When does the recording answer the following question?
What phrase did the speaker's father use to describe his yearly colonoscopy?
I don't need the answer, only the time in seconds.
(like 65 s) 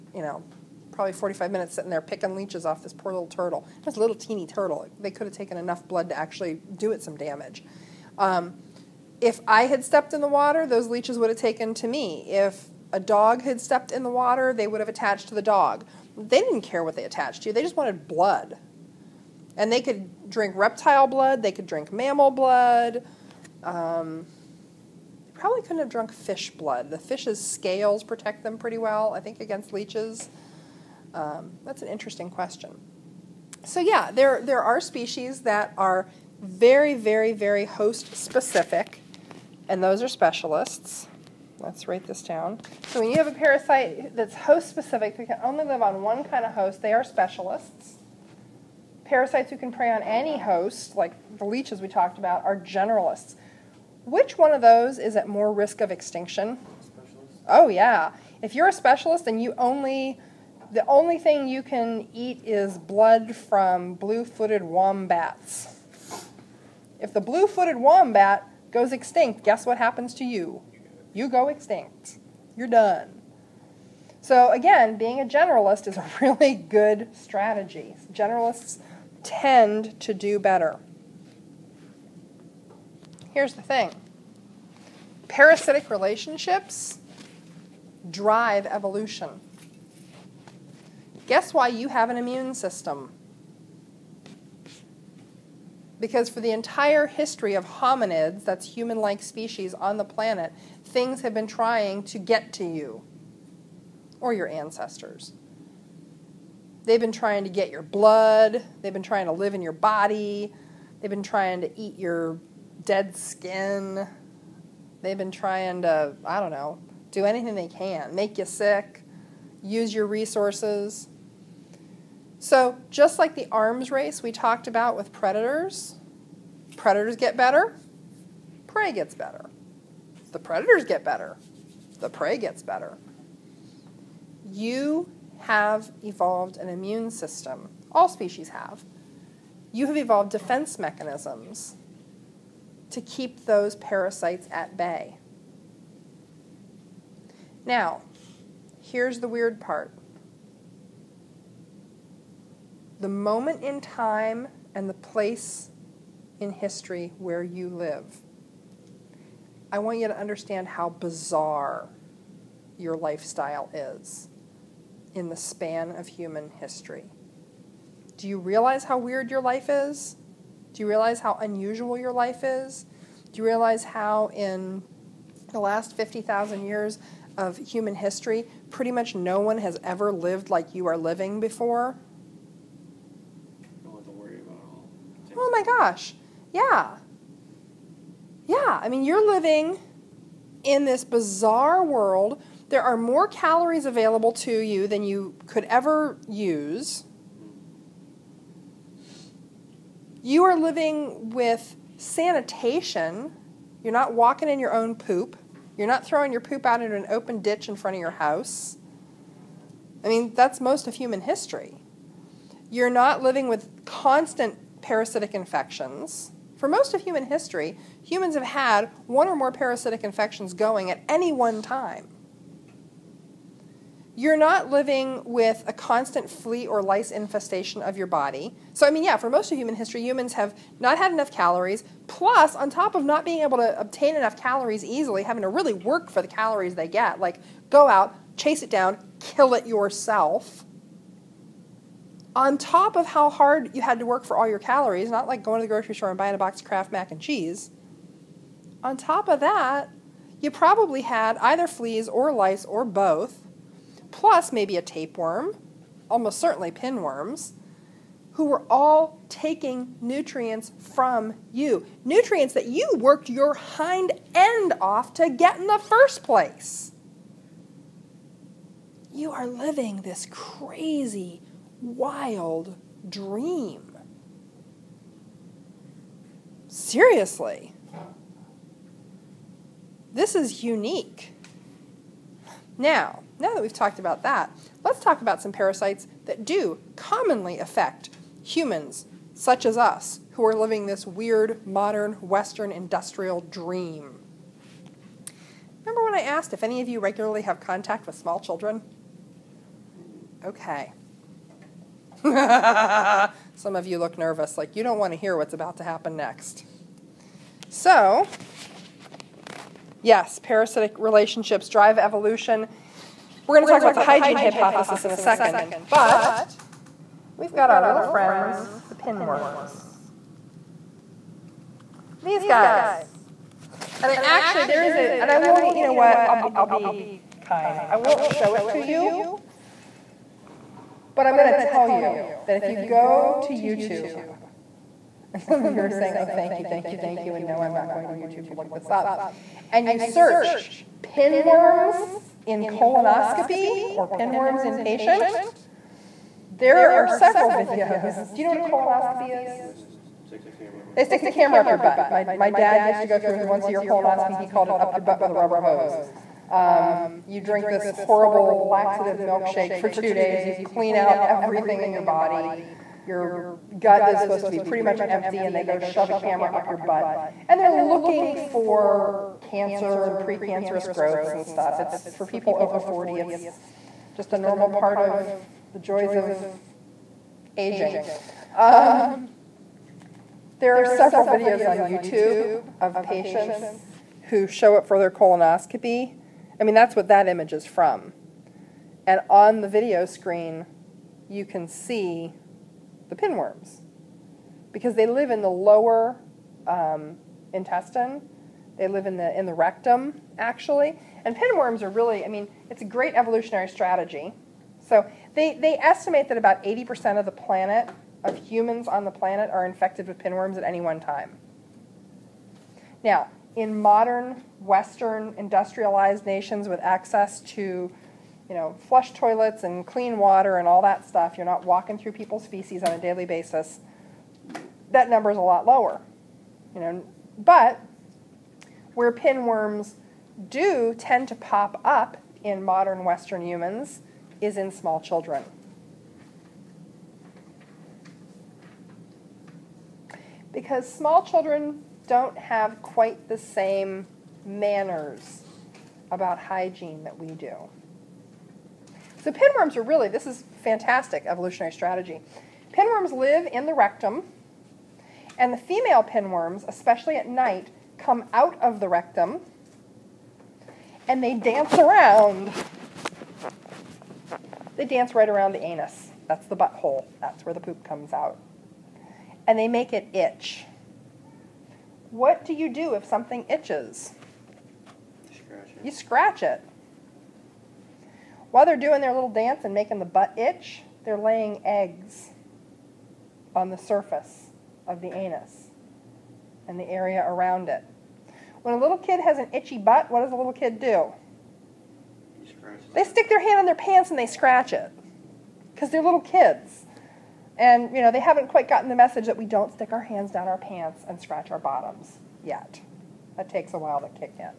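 354 s.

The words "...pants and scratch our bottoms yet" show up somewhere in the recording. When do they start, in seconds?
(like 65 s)
500 s.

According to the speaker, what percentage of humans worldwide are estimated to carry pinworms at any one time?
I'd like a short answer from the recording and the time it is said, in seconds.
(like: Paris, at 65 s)
80%, at 406 s.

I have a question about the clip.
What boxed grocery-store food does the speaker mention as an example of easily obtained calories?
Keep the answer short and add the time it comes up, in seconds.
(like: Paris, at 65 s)
Kraft mac and cheese, at 246 s.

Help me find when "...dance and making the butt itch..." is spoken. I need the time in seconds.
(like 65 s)
479 s.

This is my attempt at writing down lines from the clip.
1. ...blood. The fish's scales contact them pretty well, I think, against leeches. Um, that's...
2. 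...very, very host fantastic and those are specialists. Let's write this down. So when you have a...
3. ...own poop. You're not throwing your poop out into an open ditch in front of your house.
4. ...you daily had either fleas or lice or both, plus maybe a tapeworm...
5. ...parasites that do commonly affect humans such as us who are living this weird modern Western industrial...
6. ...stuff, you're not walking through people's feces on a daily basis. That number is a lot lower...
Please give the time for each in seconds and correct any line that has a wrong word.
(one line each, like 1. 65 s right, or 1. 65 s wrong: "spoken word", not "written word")
1. 26 s wrong: "protect", not "contact"
2. 36 s wrong: "specific", not "fantastic"
3. 204 s right
4. 250 s wrong: "probably", not "daily"
5. 285 s right
6. 421 s right.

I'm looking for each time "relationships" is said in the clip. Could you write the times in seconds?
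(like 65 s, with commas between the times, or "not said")
85 s, 310 s.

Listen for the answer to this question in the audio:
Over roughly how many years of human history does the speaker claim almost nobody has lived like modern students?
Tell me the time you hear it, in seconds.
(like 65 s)
175 s.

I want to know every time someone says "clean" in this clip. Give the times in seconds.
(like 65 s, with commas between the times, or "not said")
360 s, 419 s.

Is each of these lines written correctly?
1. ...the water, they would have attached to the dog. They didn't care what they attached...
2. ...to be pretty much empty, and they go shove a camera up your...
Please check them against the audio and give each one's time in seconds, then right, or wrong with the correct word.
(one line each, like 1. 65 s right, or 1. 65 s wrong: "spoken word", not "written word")
1. 14 s right
2. 364 s right.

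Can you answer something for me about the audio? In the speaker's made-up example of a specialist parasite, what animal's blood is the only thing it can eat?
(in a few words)
blue-footed wombats.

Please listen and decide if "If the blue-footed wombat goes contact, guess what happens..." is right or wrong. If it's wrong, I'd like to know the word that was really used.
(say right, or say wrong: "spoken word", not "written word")
wrong: "extinct", not "contact".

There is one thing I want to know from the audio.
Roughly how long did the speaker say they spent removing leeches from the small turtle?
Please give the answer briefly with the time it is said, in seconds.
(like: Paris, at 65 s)
45 minutes, at 1 s.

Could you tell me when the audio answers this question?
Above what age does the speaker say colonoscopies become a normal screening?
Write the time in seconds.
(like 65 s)
372 s.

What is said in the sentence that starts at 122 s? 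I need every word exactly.
So just like the arms race we talked about with predators, predators get better, prey gets better.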